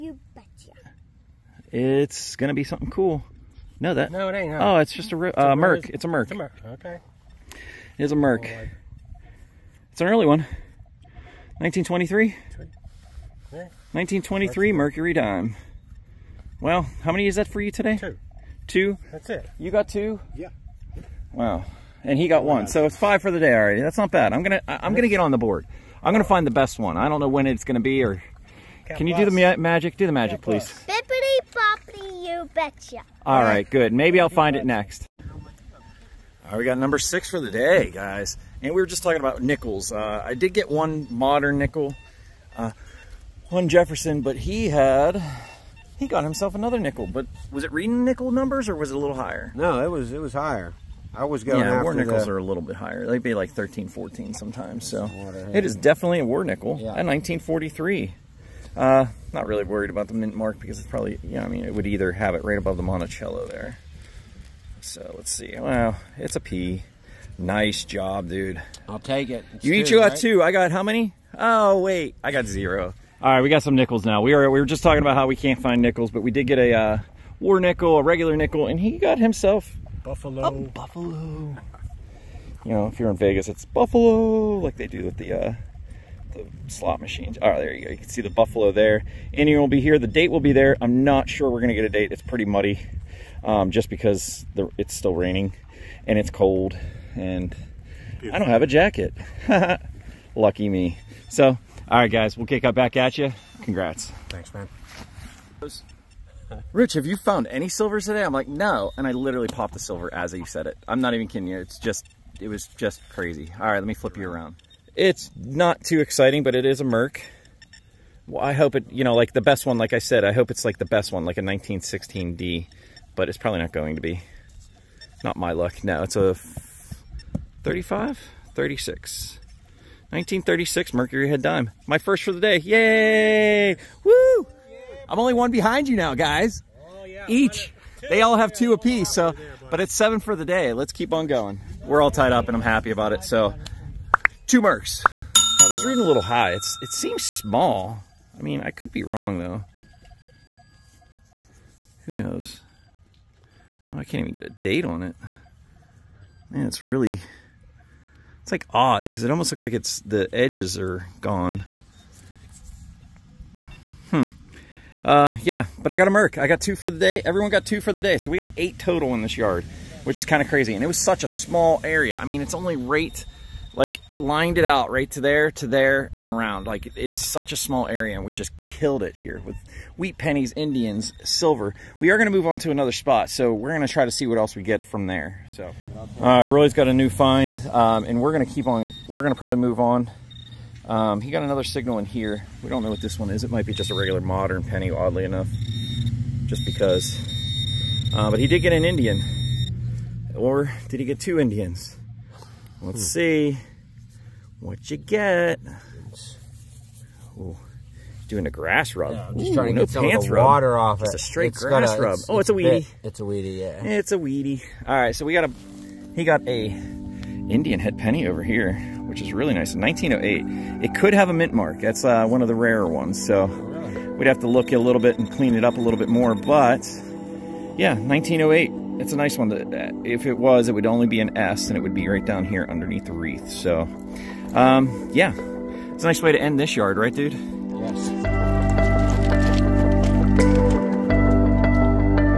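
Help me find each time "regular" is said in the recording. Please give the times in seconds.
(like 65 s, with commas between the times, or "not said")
78 s, 193 s.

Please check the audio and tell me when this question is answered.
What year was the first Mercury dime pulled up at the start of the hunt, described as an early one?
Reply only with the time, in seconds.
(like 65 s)
13 s.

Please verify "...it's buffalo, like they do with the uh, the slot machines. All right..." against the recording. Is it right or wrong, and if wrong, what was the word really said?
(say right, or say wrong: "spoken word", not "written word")
right.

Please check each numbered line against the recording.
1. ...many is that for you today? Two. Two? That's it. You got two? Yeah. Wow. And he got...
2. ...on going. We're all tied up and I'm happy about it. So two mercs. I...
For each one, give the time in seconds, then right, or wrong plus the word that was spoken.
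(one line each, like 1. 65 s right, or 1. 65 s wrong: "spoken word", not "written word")
1. 17 s right
2. 141 s right.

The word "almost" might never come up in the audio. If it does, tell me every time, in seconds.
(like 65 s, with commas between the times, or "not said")
159 s.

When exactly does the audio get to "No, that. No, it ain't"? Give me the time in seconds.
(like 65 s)
3 s.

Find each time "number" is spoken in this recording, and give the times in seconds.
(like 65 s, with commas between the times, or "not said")
36 s, 48 s.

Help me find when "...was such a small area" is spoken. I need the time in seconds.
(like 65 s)
170 s.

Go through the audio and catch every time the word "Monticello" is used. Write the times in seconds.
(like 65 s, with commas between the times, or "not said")
62 s.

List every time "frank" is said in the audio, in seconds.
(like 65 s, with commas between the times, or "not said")
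not said.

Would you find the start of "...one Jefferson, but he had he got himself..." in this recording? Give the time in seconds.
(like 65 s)
43 s.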